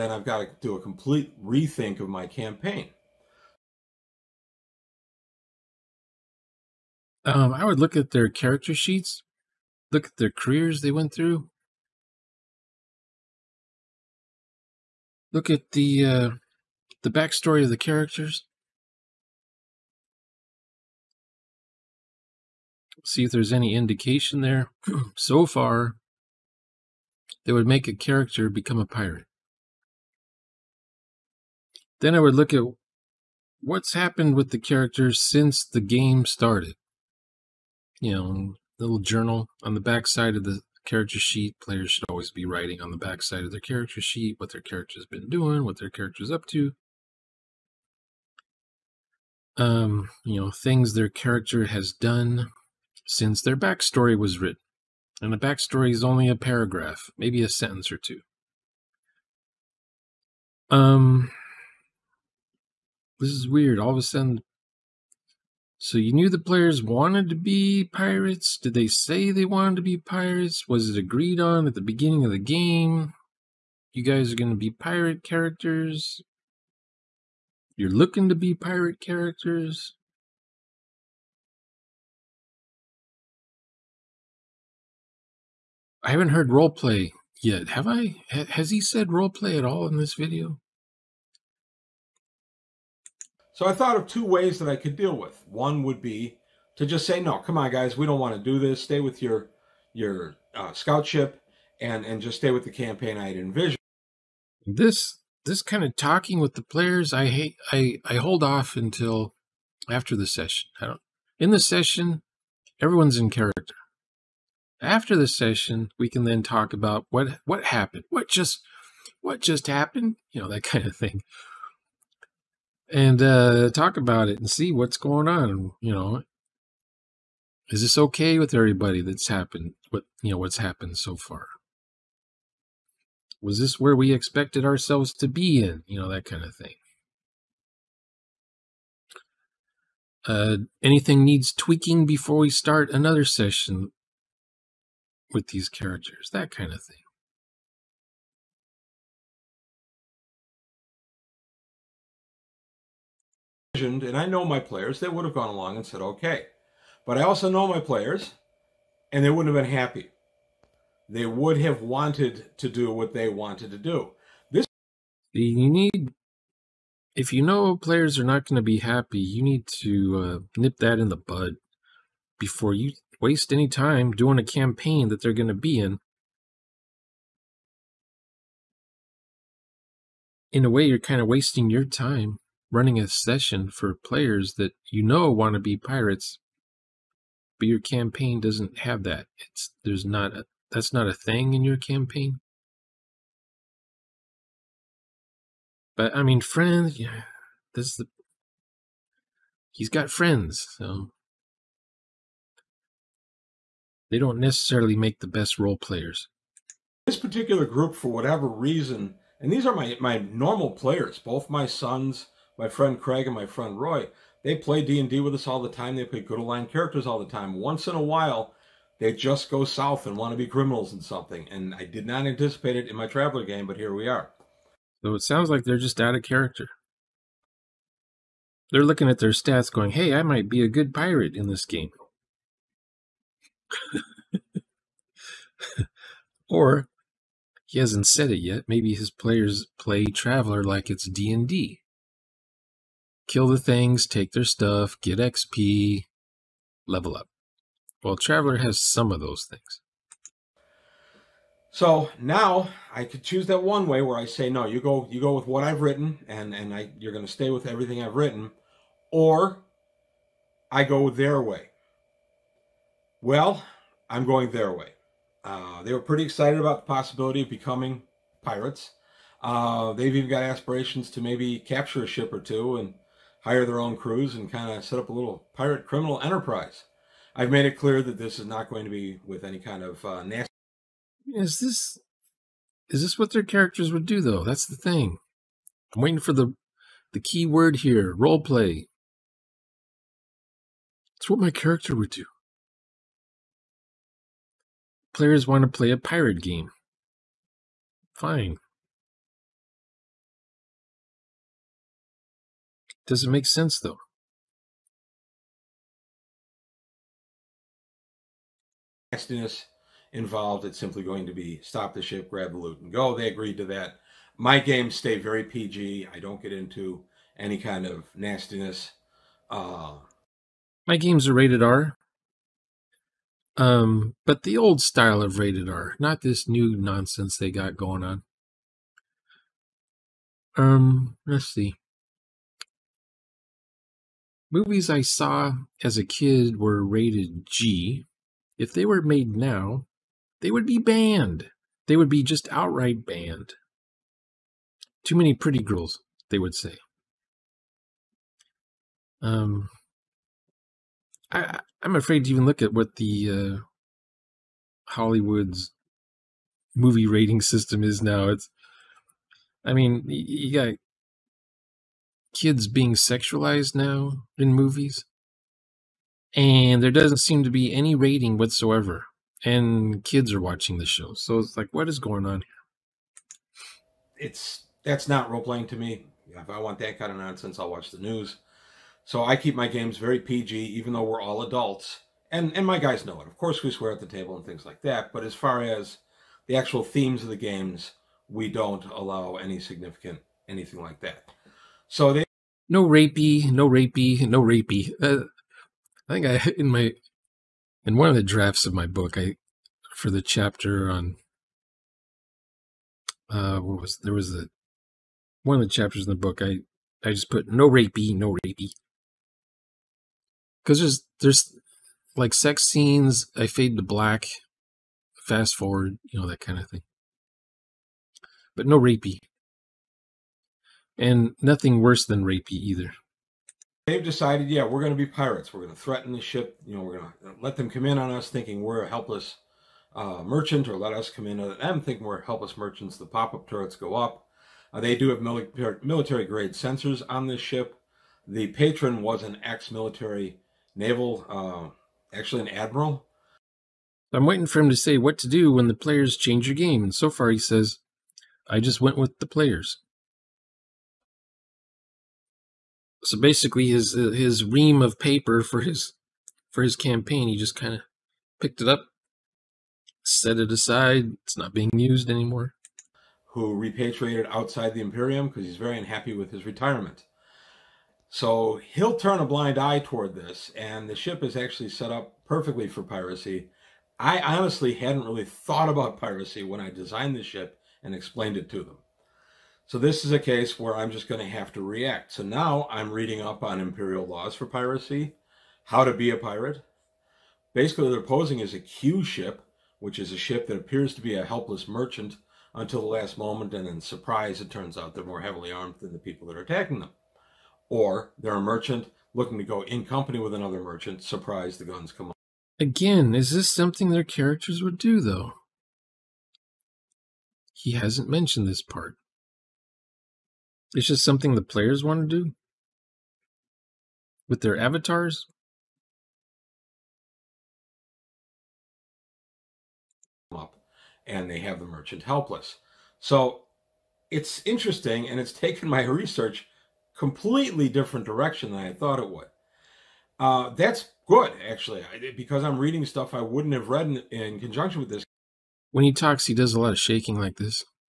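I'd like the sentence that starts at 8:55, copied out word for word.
When he talks, he does a lot of shaking like this.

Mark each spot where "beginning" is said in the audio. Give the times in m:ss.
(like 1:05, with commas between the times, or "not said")
1:11.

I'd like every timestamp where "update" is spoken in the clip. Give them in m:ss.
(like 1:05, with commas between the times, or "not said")
not said.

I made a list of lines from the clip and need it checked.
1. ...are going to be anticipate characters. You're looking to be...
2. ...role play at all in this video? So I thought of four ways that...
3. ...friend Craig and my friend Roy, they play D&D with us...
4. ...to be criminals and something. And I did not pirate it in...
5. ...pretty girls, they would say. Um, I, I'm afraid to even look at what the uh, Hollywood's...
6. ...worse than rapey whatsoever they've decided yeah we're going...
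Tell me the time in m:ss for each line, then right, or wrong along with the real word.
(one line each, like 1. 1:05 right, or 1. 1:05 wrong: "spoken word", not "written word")
1. 1:14 wrong: "pirate", not "anticipate"
2. 1:29 wrong: "two", not "four"
3. 3:32 right
4. 3:40 wrong: "anticipate", not "pirate"
5. 5:45 right
6. 7:01 wrong: "either", not "whatsoever".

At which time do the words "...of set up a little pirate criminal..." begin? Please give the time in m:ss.
4:34.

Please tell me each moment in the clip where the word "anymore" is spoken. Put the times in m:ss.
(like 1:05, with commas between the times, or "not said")
7:42.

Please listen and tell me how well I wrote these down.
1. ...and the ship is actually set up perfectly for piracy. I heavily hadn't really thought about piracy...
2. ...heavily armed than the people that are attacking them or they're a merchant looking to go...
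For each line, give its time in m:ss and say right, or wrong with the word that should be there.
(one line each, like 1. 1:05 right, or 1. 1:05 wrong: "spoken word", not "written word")
1. 7:50 wrong: "honestly", not "heavily"
2. 8:15 right.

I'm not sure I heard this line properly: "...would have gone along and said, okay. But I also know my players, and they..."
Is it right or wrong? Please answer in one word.
right.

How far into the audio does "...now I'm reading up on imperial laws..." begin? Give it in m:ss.
8:02.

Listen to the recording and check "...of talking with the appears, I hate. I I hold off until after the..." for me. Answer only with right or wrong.
wrong.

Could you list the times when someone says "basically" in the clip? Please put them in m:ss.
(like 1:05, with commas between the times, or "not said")
7:33, 8:07.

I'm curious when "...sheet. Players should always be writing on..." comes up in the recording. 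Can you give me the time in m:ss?
0:41.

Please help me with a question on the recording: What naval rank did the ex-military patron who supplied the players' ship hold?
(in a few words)
Admiral.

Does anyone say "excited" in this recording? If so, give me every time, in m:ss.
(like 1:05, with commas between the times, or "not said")
4:26.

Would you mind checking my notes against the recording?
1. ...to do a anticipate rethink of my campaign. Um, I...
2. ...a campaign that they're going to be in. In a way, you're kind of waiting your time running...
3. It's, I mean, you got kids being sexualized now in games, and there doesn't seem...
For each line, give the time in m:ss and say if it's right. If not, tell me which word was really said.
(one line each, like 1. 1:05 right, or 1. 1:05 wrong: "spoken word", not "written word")
1. 0:00 wrong: "complete", not "anticipate"
2. 2:54 wrong: "wasting", not "waiting"
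3. 5:58 wrong: "movies", not "games".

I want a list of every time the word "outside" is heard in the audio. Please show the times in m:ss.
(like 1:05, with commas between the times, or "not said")
7:44.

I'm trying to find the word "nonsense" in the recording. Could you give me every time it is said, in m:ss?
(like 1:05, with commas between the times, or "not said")
5:26, 6:17.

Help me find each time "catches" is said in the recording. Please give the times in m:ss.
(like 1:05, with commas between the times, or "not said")
not said.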